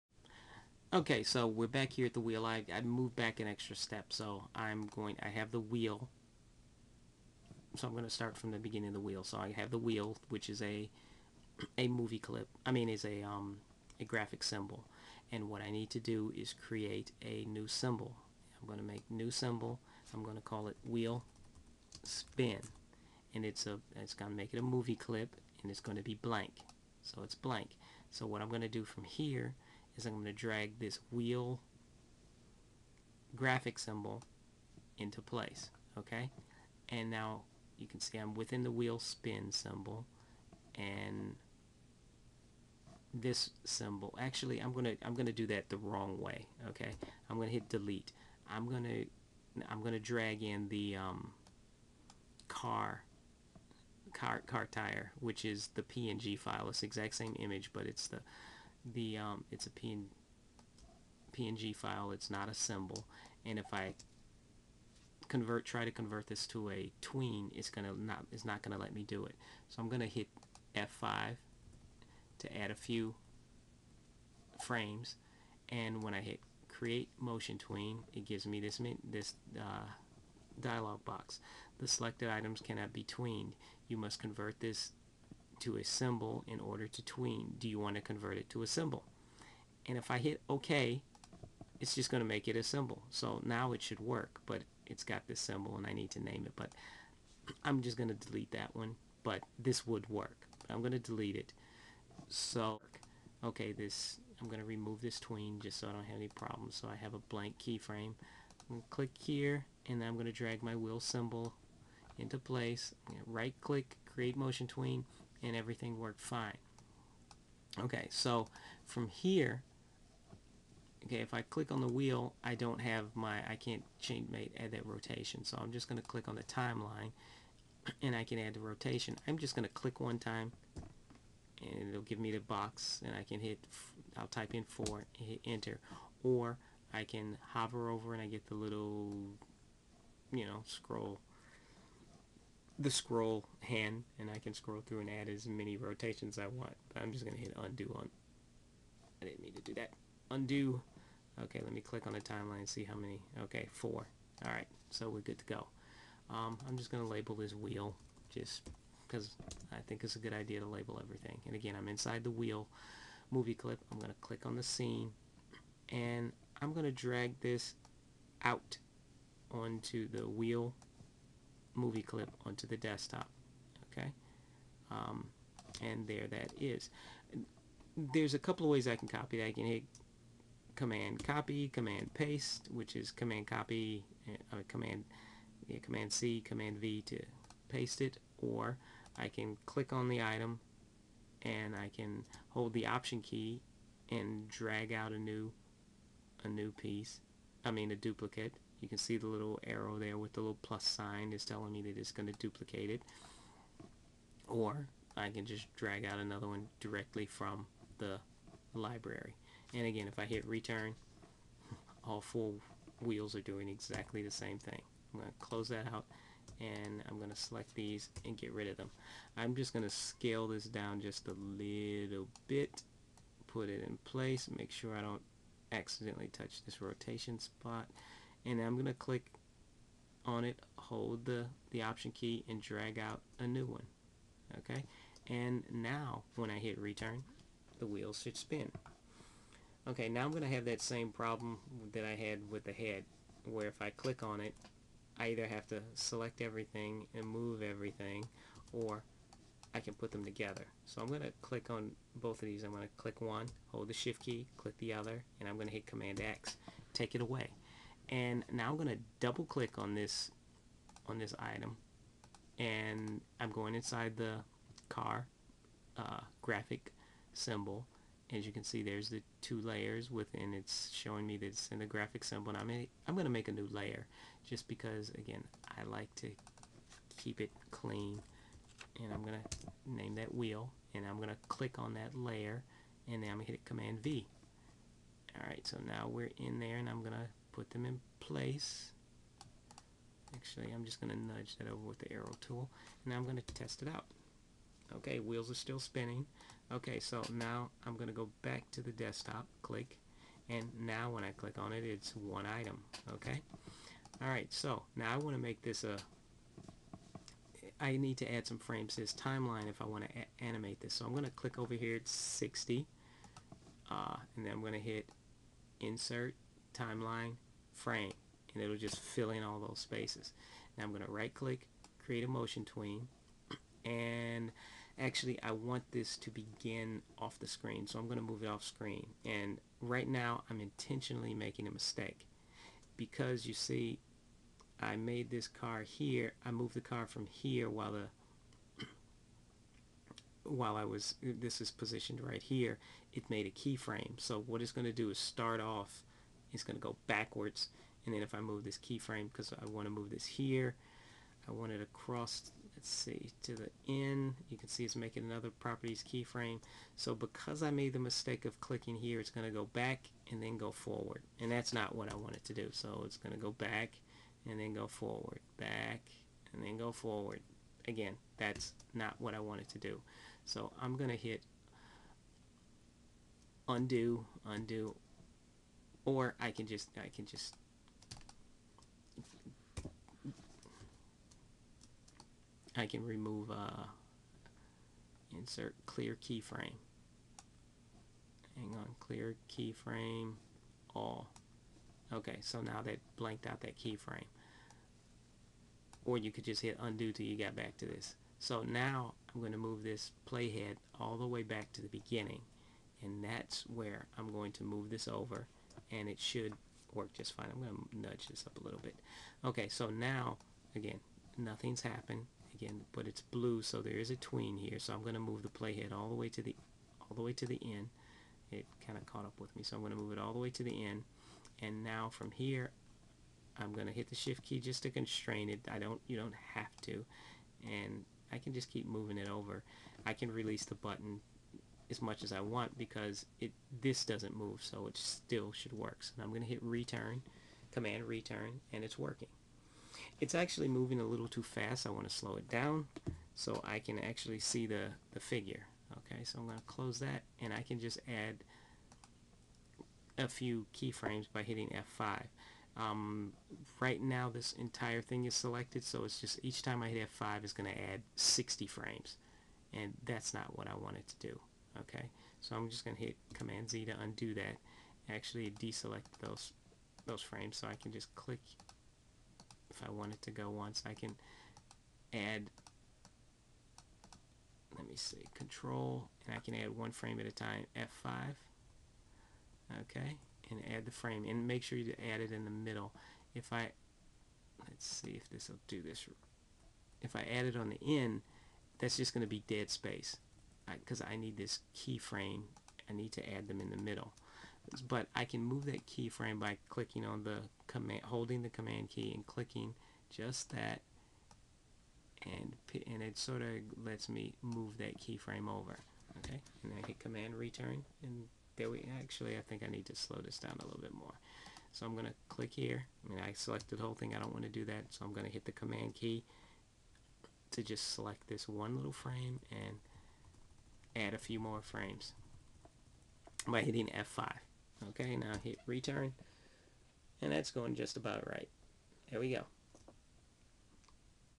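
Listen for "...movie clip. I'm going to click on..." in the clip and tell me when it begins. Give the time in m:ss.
2:43.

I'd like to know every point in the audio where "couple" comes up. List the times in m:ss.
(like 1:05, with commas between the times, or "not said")
2:58.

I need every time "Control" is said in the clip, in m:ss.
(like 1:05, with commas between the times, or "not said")
7:55.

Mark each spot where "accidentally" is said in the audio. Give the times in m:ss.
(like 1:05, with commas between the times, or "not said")
3:45.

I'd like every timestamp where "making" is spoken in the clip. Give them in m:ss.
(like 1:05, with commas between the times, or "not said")
5:31, 5:54.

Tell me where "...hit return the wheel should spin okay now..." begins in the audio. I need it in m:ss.
3:56.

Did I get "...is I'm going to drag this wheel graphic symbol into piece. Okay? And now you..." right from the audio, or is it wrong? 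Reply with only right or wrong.
wrong.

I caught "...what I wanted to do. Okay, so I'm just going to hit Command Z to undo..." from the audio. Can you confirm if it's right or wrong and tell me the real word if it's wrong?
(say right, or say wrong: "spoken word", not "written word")
right.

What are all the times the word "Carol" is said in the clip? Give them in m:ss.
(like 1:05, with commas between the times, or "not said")
not said.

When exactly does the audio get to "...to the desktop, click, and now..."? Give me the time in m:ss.
4:58.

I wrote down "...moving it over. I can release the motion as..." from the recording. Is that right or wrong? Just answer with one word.
wrong.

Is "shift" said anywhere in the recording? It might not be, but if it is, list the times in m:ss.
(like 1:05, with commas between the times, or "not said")
4:13, 7:04.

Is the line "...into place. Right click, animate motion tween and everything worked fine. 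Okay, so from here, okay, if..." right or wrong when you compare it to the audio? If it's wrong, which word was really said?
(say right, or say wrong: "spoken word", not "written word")
wrong: "create", not "animate".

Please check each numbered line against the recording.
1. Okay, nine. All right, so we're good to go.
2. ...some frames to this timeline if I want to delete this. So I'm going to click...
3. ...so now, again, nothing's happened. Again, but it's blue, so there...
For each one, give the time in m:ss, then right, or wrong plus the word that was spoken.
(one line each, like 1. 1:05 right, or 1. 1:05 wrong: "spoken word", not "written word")
1. 2:33 wrong: "four", not "nine"
2. 5:08 wrong: "animate", not "delete"
3. 6:49 right.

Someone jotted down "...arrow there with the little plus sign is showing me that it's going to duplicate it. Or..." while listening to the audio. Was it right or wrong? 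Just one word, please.
wrong.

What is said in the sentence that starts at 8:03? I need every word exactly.
If I, let's see if this will do this.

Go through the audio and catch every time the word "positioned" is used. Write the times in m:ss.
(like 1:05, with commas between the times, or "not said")
5:41.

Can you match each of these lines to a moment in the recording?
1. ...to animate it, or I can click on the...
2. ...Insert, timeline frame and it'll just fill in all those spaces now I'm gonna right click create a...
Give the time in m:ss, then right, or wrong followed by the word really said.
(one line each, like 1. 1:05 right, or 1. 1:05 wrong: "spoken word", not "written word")
1. 3:07 wrong: "paste", not "animate"
2. 5:15 right.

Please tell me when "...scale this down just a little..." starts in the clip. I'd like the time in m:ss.
3:39.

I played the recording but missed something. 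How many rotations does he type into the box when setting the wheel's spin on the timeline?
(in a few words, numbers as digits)
4.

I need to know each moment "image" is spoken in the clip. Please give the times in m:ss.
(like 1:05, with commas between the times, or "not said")
0:57.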